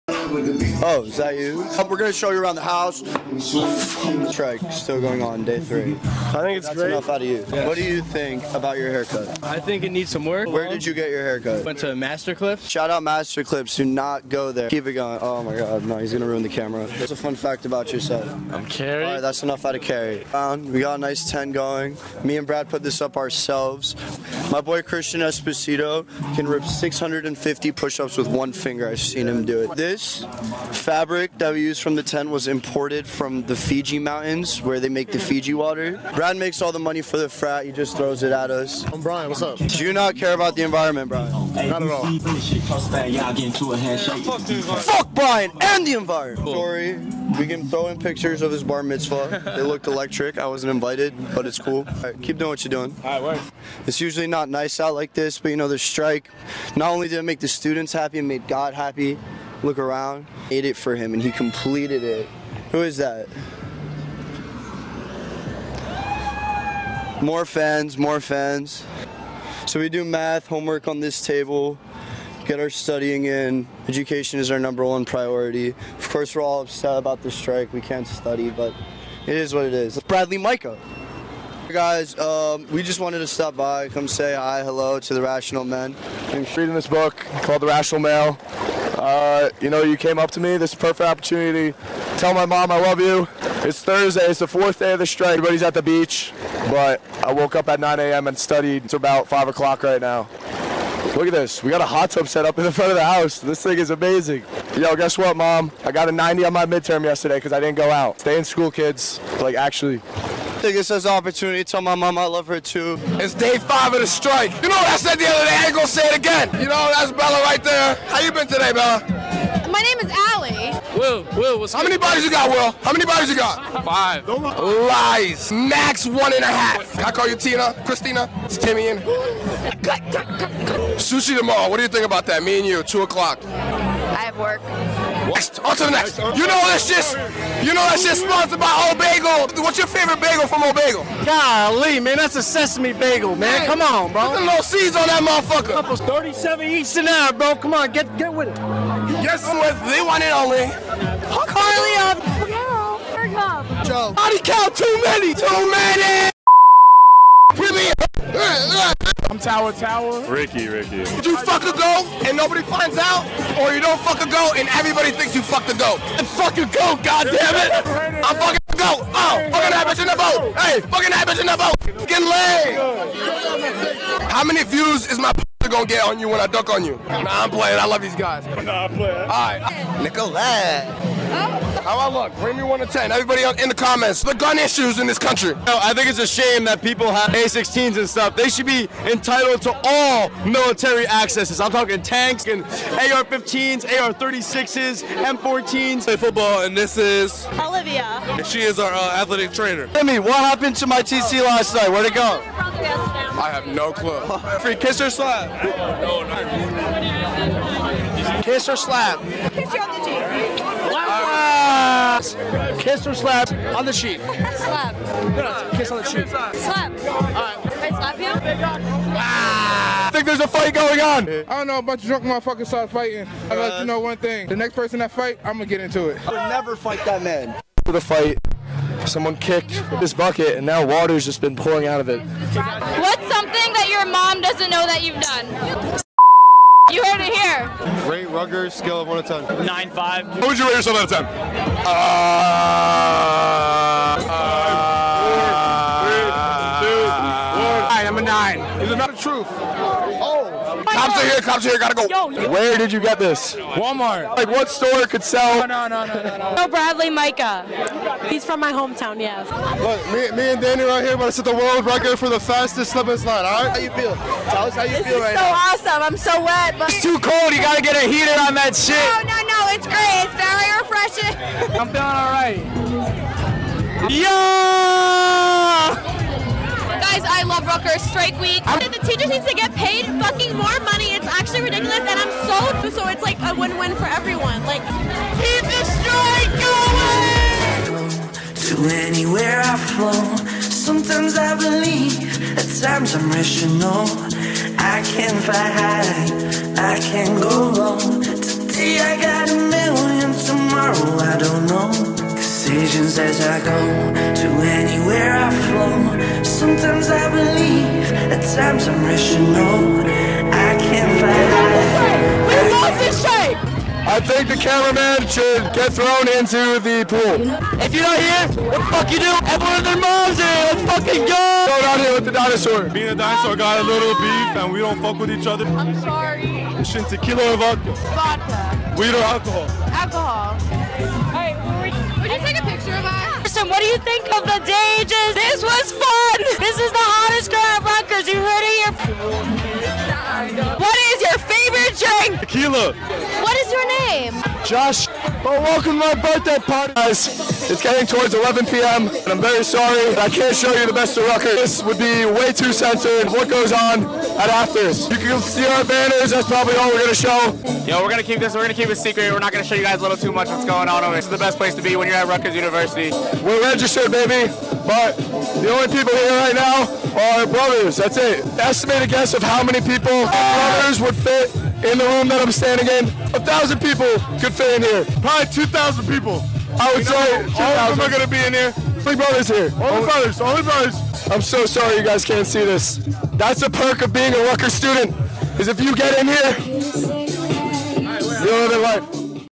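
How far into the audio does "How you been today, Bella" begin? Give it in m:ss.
1:58.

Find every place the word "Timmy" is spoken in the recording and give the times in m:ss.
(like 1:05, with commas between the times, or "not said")
2:08, 3:19.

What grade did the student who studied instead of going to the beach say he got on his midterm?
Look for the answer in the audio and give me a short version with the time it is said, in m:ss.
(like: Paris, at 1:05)
90, at 1:46.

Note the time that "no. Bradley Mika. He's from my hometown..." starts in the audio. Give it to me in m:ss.
4:16.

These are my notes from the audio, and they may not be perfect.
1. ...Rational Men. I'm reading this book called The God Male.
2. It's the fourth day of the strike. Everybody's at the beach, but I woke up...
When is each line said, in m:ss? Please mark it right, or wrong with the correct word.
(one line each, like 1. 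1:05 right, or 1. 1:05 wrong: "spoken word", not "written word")
1. 1:25 wrong: "Rational", not "God"
2. 1:34 right.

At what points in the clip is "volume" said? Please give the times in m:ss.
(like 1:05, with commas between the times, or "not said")
not said.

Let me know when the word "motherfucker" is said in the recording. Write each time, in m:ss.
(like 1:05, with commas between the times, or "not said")
2:25, 3:42.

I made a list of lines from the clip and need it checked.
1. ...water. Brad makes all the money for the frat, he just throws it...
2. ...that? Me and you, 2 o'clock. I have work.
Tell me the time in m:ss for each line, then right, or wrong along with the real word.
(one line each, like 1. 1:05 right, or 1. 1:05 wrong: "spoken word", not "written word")
1. 0:35 right
2. 2:12 right.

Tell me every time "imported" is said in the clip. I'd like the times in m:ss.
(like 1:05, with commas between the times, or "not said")
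0:32.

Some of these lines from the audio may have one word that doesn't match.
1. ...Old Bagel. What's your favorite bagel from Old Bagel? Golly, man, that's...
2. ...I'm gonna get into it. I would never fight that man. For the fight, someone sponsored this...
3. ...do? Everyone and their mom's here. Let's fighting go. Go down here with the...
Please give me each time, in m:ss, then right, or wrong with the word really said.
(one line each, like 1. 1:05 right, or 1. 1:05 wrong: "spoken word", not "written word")
1. 2:18 right
2. 3:45 wrong: "kicked", not "sponsored"
3. 5:19 wrong: "fucking", not "fighting".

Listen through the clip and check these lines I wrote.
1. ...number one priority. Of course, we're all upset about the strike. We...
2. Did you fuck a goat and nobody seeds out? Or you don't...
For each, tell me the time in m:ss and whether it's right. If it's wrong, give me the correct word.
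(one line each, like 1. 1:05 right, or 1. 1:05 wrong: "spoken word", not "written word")
1. 1:14 right
2. 2:41 wrong: "finds", not "seeds".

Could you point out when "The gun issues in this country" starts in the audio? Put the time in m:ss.
3:04.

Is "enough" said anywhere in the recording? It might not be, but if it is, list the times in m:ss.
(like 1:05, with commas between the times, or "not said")
0:06, 0:19.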